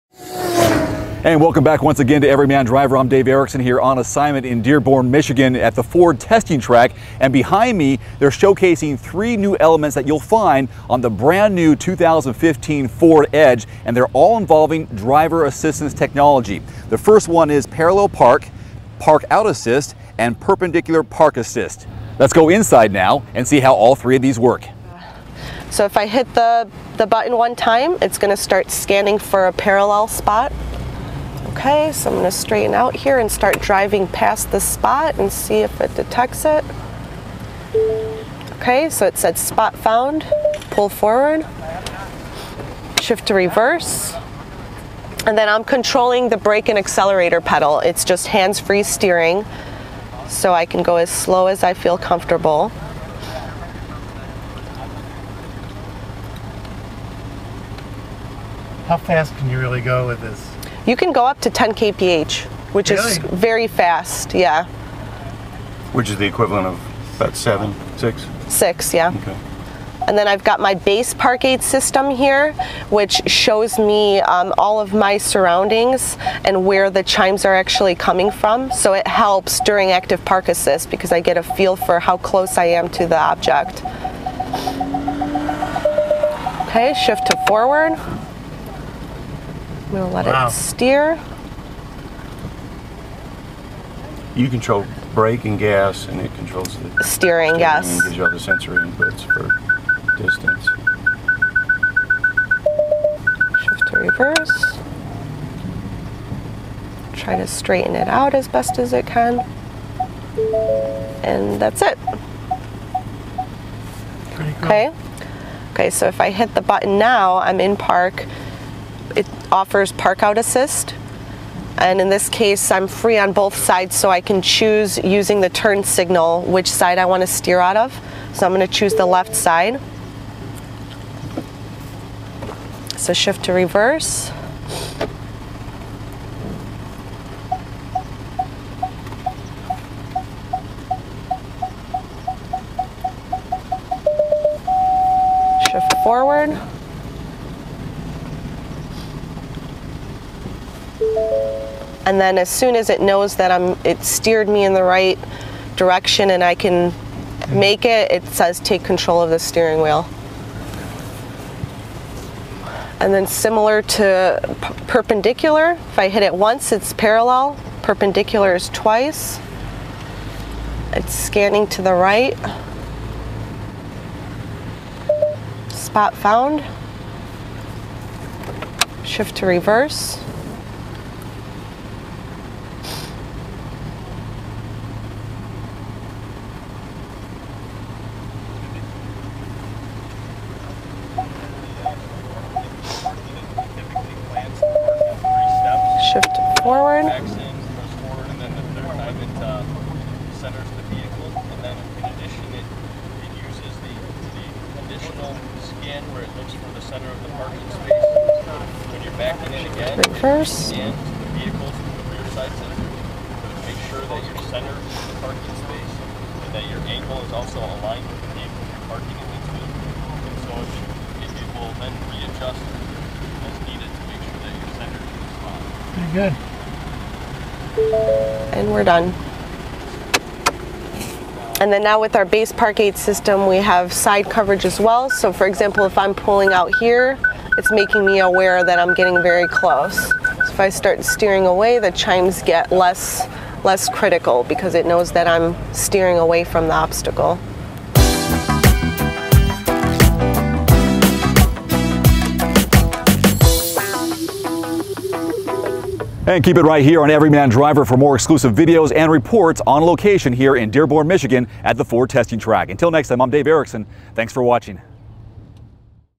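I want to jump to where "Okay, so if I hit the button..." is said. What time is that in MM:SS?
01:55.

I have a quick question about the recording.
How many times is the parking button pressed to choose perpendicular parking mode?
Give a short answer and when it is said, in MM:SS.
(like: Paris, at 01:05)
Twice, at 02:47.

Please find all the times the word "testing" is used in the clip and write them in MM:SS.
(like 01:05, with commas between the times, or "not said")
00:06, 04:22.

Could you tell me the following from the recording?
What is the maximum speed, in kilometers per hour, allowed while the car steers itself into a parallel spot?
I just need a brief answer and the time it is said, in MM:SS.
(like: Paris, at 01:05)
10 kph, at 01:01.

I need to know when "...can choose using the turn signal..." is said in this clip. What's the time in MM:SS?
02:04.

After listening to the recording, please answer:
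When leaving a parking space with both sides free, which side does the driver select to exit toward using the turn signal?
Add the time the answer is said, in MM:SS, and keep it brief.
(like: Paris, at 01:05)
Left, at 02:09.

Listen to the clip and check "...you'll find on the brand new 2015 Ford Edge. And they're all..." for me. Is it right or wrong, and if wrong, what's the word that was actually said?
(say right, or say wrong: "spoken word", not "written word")
right.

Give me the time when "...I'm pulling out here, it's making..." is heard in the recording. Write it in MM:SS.
03:55.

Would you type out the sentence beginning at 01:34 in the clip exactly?
You control brake and gas, and it controls the steering.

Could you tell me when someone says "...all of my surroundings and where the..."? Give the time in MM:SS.
01:14.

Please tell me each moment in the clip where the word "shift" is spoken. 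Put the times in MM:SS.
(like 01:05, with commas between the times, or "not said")
00:43, 01:27, 01:43, 02:13, 02:25, 02:59.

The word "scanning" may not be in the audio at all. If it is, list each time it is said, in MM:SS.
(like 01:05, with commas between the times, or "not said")
00:28, 02:51.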